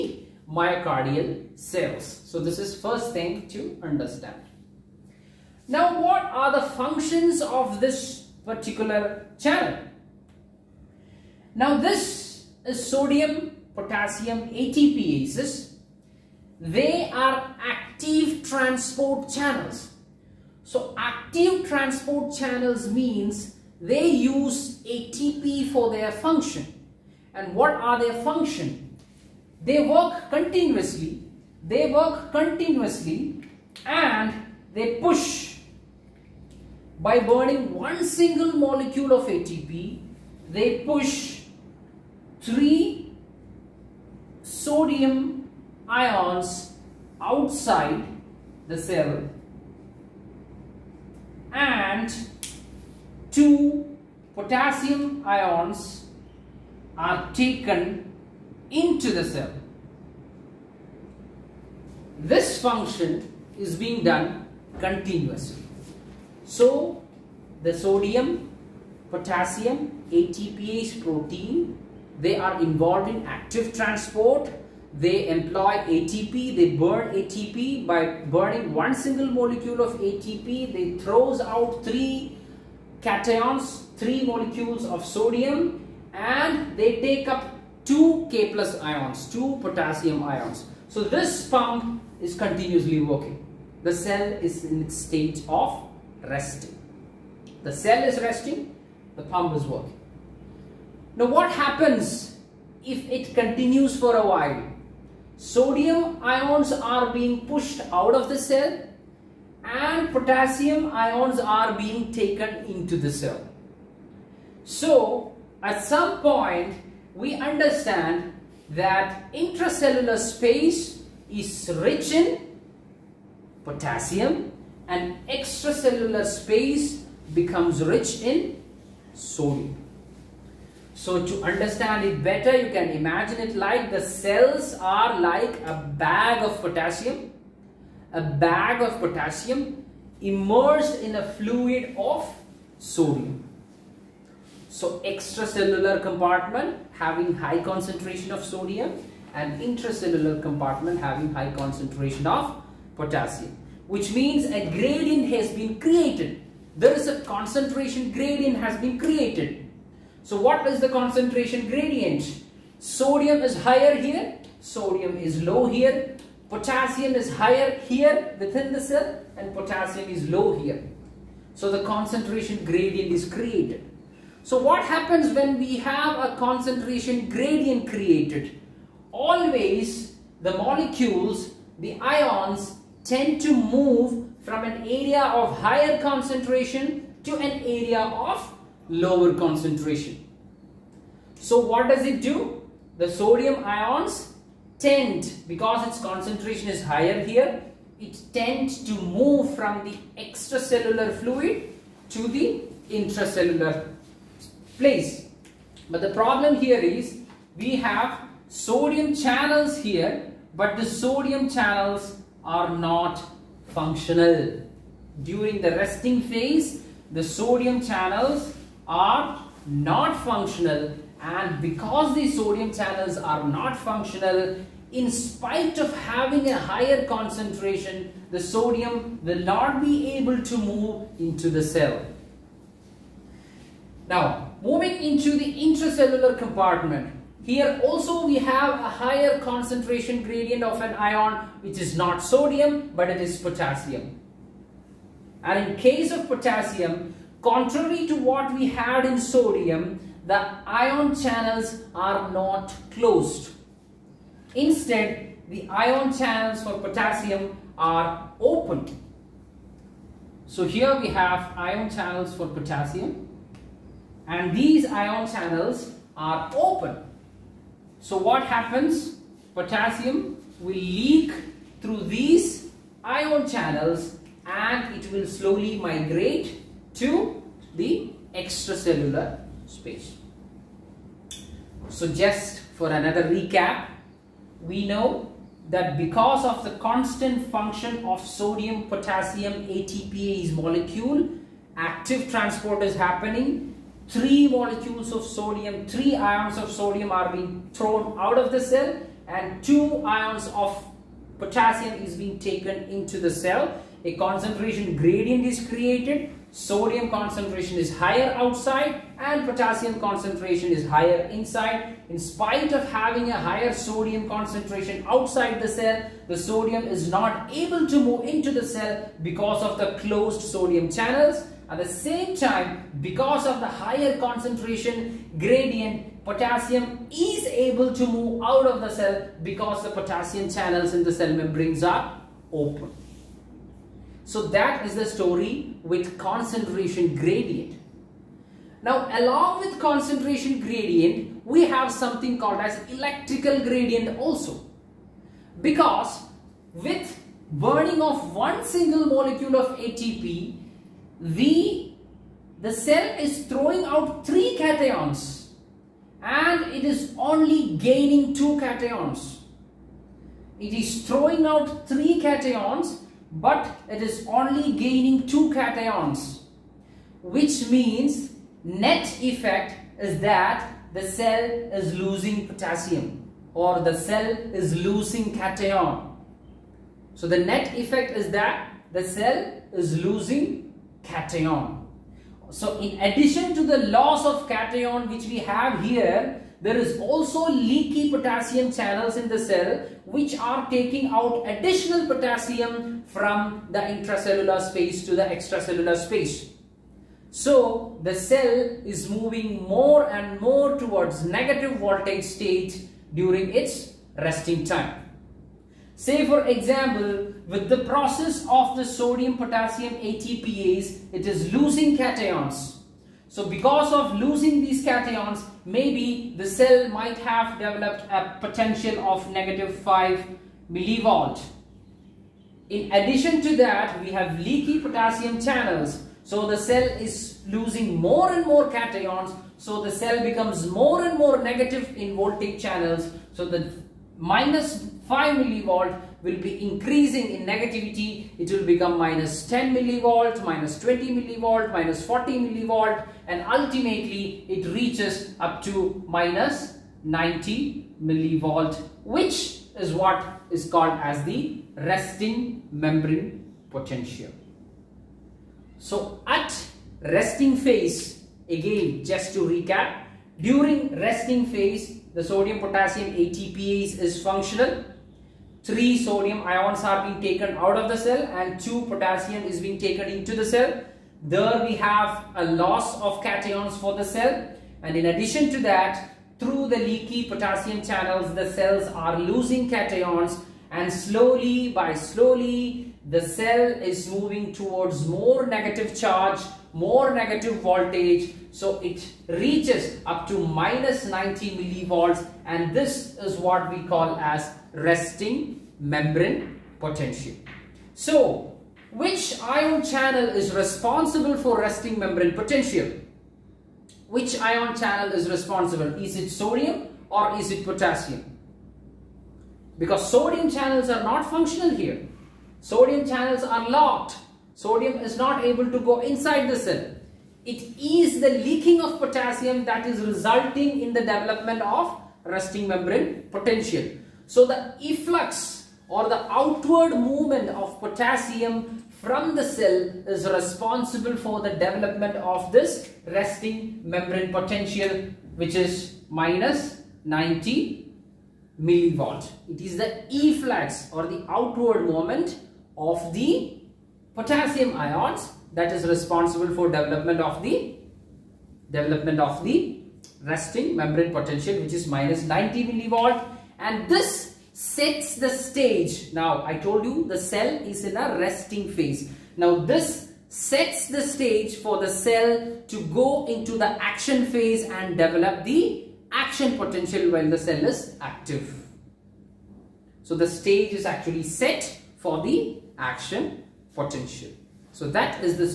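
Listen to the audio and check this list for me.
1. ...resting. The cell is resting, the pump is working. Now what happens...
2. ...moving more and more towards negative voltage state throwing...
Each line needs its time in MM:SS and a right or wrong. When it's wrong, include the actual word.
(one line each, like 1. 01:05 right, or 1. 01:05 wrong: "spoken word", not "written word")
1. 01:36 right
2. 06:39 wrong: "during", not "throwing".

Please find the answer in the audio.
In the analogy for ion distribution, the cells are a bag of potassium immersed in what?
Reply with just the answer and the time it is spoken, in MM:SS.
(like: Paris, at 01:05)
A fluid of sodium, at 02:21.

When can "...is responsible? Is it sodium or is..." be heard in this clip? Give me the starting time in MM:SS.
08:25.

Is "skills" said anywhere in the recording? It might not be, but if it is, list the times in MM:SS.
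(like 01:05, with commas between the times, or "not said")
not said.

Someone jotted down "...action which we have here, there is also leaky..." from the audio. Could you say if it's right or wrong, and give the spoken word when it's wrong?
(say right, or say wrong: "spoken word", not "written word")
wrong: "cation", not "action".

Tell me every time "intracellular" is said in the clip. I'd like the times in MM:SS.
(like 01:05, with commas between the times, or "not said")
01:59, 02:29, 03:22, 03:55, 06:33.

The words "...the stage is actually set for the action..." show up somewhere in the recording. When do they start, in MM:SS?
09:30.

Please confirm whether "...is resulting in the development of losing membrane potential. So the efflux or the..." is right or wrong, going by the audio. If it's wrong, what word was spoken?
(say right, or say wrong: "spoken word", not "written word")
wrong: "resting", not "losing".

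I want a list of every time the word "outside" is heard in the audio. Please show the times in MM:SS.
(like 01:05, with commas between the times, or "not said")
00:47, 05:08, 05:15.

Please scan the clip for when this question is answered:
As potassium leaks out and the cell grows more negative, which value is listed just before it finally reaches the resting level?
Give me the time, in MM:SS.
07:21.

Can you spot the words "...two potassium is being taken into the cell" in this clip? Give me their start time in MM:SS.
07:48.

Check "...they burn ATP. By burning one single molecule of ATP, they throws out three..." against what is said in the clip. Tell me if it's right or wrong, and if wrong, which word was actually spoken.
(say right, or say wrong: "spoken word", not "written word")
right.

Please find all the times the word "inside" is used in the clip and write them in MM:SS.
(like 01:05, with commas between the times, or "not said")
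05:11, 08:35.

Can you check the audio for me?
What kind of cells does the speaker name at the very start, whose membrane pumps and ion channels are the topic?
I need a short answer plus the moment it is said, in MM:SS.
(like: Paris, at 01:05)
Myocardial cells, at 00:00.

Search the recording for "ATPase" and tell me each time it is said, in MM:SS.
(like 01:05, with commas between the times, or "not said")
00:14, 01:10, 04:49, 06:49, 07:43.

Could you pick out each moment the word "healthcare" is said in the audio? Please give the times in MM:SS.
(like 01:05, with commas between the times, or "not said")
not said.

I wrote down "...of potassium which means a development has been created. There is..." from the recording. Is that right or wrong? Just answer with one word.
wrong.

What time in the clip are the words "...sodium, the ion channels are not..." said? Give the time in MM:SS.
04:09.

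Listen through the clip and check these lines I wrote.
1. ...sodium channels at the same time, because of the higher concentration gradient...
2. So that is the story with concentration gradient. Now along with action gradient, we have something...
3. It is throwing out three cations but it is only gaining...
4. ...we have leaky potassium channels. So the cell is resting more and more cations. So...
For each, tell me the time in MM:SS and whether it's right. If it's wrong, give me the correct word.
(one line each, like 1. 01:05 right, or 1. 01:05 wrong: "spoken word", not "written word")
1. 05:20 right
2. 05:34 wrong: "concentration", not "action"
3. 06:00 right
4. 07:04 wrong: "losing", not "resting".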